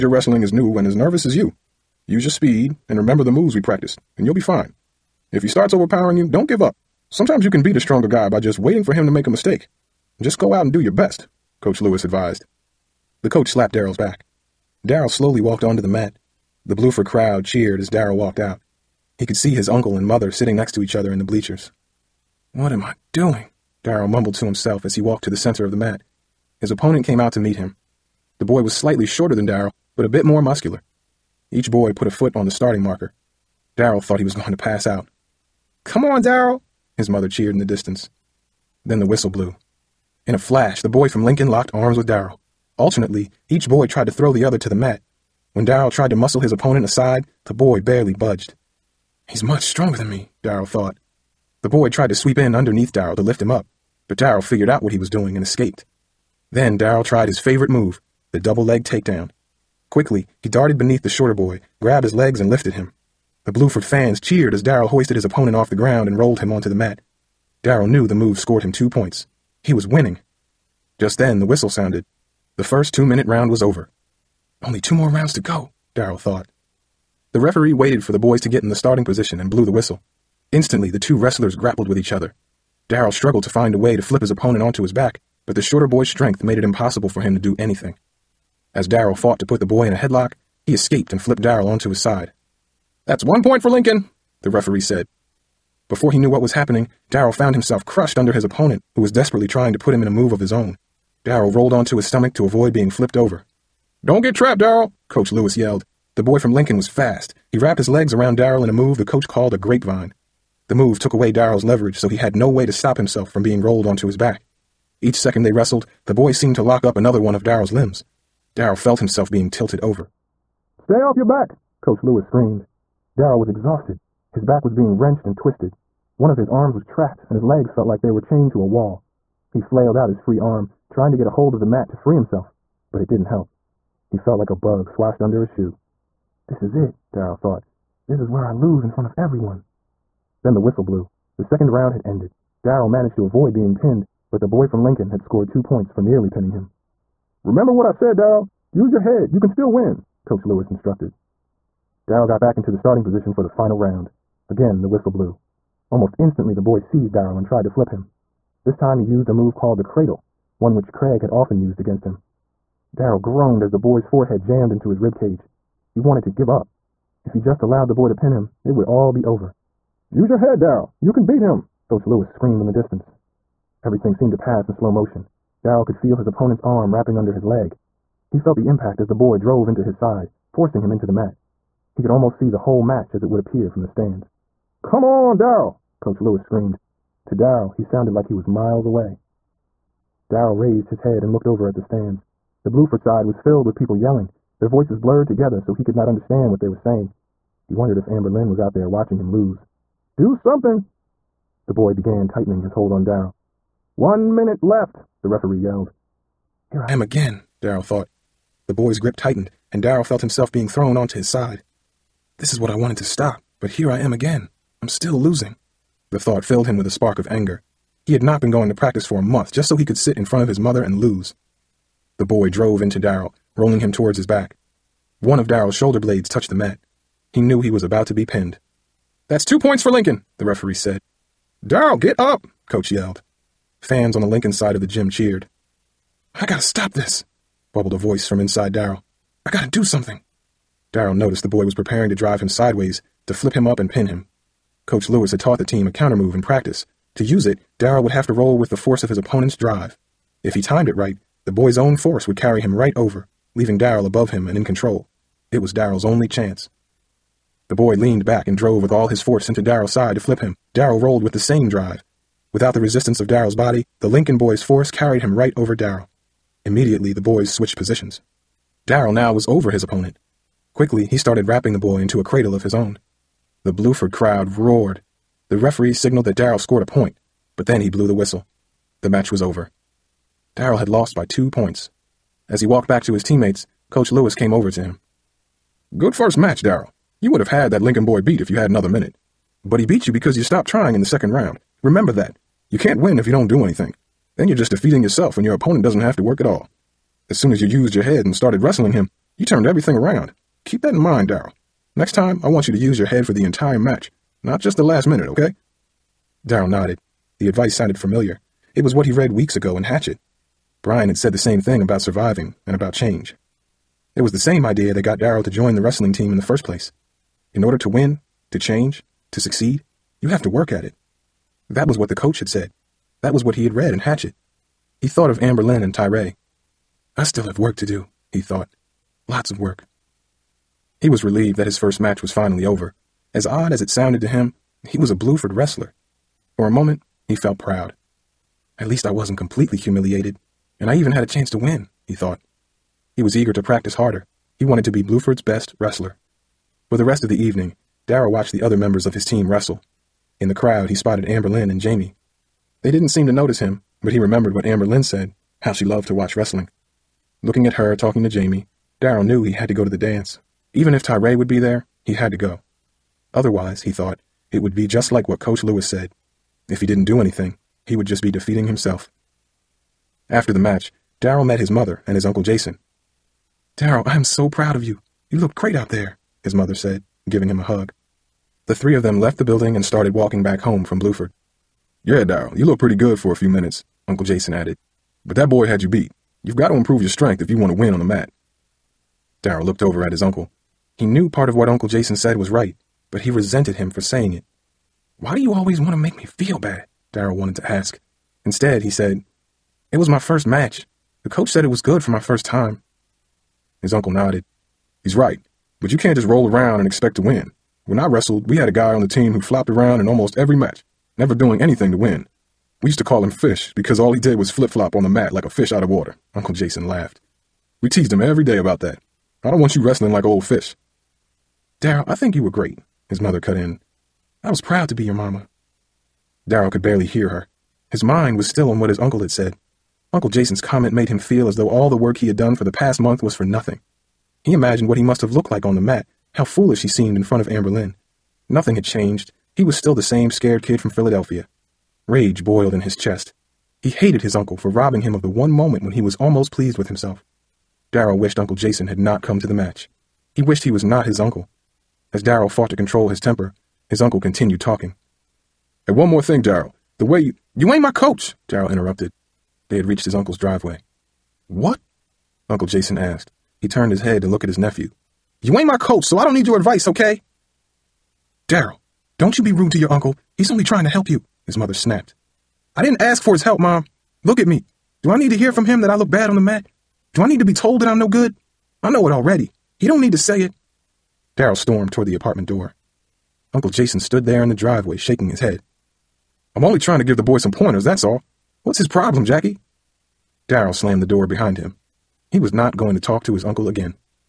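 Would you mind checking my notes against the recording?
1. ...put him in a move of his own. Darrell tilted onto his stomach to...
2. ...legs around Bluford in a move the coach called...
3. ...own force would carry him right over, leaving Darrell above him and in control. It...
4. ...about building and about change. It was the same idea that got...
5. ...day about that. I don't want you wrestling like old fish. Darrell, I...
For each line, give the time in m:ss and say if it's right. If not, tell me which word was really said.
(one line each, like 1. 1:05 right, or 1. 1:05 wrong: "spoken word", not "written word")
1. 1:39 wrong: "rolled", not "tilted"
2. 1:47 wrong: "Darrell", not "Bluford"
3. 4:11 right
4. 5:11 wrong: "surviving", not "building"
5. 6:58 right.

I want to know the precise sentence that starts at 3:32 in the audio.
This is what I wanted to stop, but here I am again.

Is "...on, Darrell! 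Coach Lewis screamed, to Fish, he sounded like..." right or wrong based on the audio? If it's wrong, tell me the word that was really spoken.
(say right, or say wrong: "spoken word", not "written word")
wrong: "Darrell", not "Fish".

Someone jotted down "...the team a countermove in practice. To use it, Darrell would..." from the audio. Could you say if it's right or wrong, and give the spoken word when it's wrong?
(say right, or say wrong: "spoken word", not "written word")
right.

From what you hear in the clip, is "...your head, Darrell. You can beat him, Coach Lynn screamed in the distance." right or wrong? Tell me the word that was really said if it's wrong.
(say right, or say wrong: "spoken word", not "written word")
wrong: "Lewis", not "Lynn".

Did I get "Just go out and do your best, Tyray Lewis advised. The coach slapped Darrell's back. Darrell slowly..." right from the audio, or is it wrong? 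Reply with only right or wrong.
wrong.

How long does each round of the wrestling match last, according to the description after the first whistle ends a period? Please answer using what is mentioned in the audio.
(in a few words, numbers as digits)
2 minutes.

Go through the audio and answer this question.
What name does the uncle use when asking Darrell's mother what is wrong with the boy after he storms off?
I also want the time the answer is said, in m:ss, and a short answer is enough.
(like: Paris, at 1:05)
Jackie, at 8:09.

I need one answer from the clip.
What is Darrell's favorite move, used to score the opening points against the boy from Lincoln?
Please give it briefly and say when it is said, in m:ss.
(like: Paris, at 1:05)
double leg takedown, at 0:58.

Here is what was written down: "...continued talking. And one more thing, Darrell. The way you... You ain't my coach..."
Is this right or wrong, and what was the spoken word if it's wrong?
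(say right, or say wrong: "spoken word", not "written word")
right.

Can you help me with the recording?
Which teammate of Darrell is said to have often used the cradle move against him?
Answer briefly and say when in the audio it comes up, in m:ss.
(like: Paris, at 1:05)
Craig, at 2:40.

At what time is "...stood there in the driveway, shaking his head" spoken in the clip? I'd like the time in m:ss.
8:03.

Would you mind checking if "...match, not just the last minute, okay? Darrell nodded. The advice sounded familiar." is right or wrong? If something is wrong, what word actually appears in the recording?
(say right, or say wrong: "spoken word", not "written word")
right.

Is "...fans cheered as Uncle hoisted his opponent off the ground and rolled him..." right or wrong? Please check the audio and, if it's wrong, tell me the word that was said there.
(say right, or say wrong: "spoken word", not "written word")
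wrong: "Darrell", not "Uncle".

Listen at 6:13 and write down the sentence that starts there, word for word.
Darrell, I am so proud of you.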